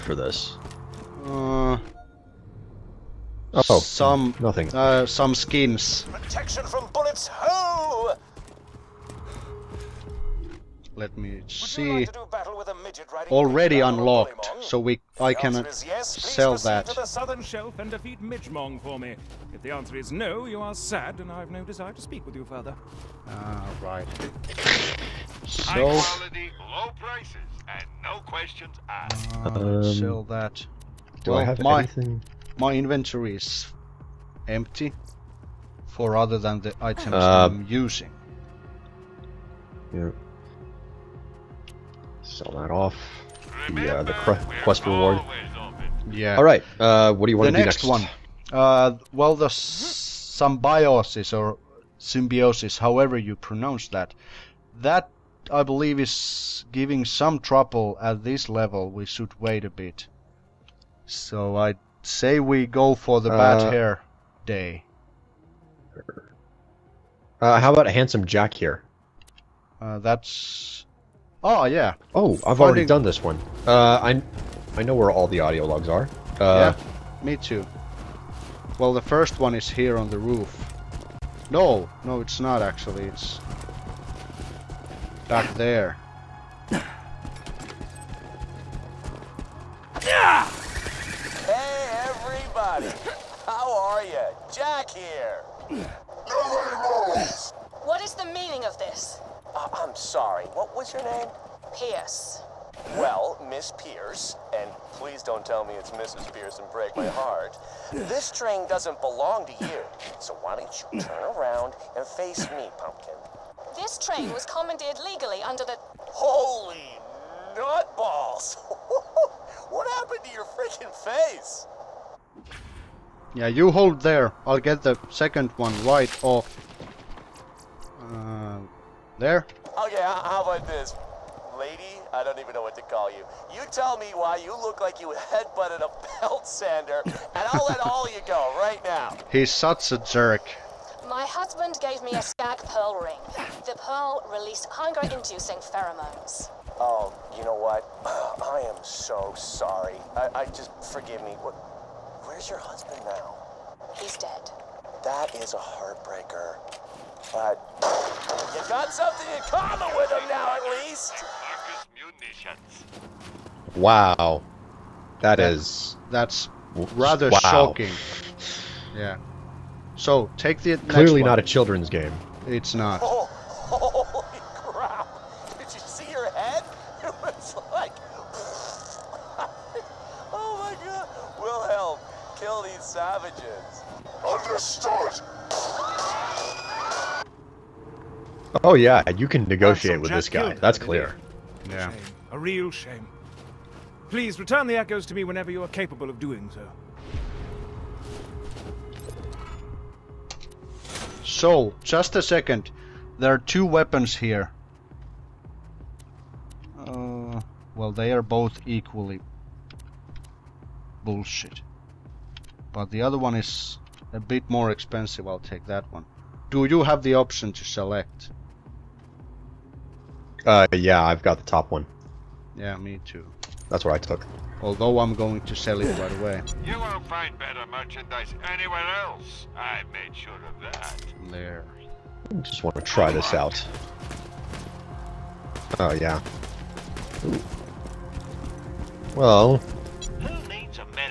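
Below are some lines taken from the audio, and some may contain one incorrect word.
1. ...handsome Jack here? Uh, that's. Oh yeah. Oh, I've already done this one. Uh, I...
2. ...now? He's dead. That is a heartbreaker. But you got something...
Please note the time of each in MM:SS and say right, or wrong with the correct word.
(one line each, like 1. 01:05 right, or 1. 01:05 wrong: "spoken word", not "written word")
1. 01:07 right
2. 02:33 right.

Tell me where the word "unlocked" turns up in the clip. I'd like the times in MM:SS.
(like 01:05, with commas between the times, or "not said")
00:13.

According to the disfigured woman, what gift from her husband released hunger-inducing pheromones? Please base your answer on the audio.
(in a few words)
skag pearl ring.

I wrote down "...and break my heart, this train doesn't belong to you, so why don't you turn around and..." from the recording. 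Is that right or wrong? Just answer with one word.
right.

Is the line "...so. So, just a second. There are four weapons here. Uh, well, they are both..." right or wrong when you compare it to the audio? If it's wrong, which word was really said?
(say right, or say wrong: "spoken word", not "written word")
wrong: "two", not "four".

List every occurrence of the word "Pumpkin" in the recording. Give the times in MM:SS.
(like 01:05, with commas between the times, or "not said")
01:52.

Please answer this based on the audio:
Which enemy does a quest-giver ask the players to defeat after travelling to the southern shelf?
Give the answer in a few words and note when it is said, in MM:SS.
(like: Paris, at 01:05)
Midgemong, at 00:18.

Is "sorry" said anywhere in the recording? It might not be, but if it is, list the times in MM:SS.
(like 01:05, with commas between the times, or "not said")
01:39, 02:29.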